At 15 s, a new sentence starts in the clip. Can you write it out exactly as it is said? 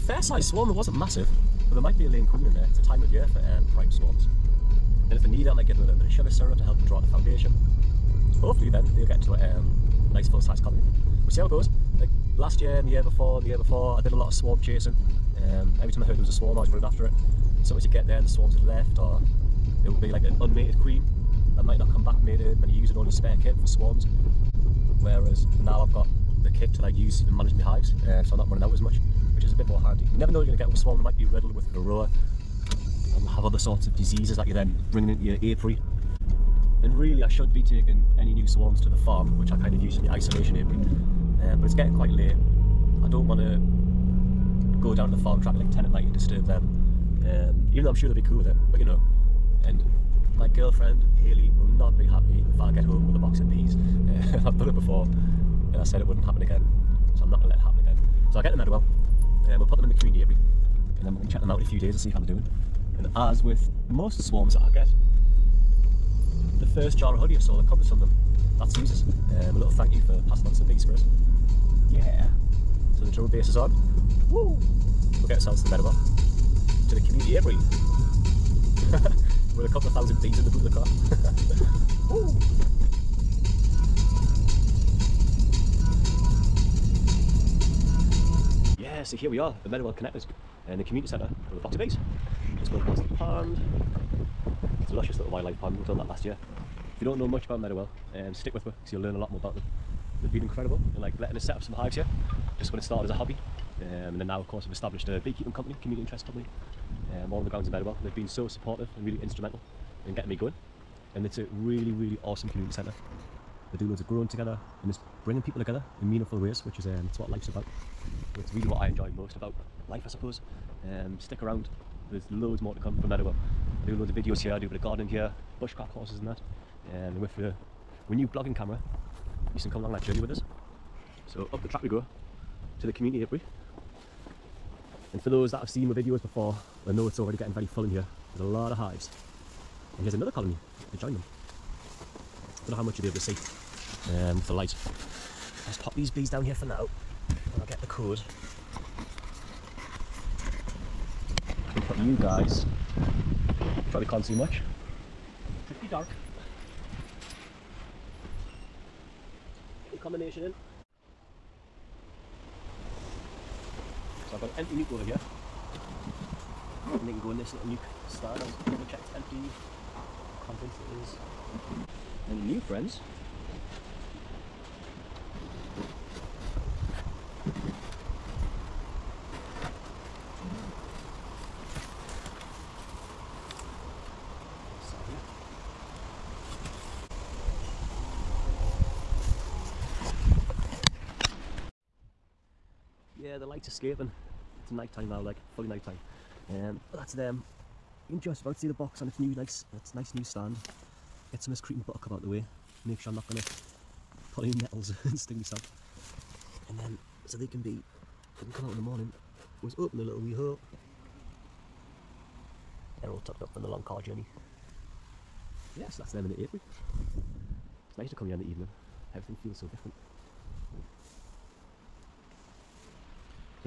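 Um, every time I heard there was a swarm, I was running after it.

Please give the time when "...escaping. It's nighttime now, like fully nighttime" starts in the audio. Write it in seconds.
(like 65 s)
193 s.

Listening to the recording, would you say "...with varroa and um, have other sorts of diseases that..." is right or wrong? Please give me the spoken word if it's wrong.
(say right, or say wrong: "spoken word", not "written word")
right.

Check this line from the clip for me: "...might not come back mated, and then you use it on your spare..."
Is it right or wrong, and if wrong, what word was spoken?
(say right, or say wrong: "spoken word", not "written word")
right.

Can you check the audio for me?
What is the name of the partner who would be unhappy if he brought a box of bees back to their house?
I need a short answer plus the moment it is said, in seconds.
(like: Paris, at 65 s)
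Haley, at 51 s.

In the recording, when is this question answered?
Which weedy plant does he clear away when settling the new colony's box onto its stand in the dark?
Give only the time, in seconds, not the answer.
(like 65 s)
201 s.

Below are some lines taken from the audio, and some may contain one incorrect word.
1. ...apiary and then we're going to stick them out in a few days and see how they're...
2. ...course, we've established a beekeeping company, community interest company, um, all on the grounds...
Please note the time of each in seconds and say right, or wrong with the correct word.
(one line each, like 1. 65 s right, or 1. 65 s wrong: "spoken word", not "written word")
1. 60 s wrong: "check", not "stick"
2. 104 s right.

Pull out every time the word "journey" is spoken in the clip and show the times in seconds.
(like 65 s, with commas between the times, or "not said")
130 s, 214 s.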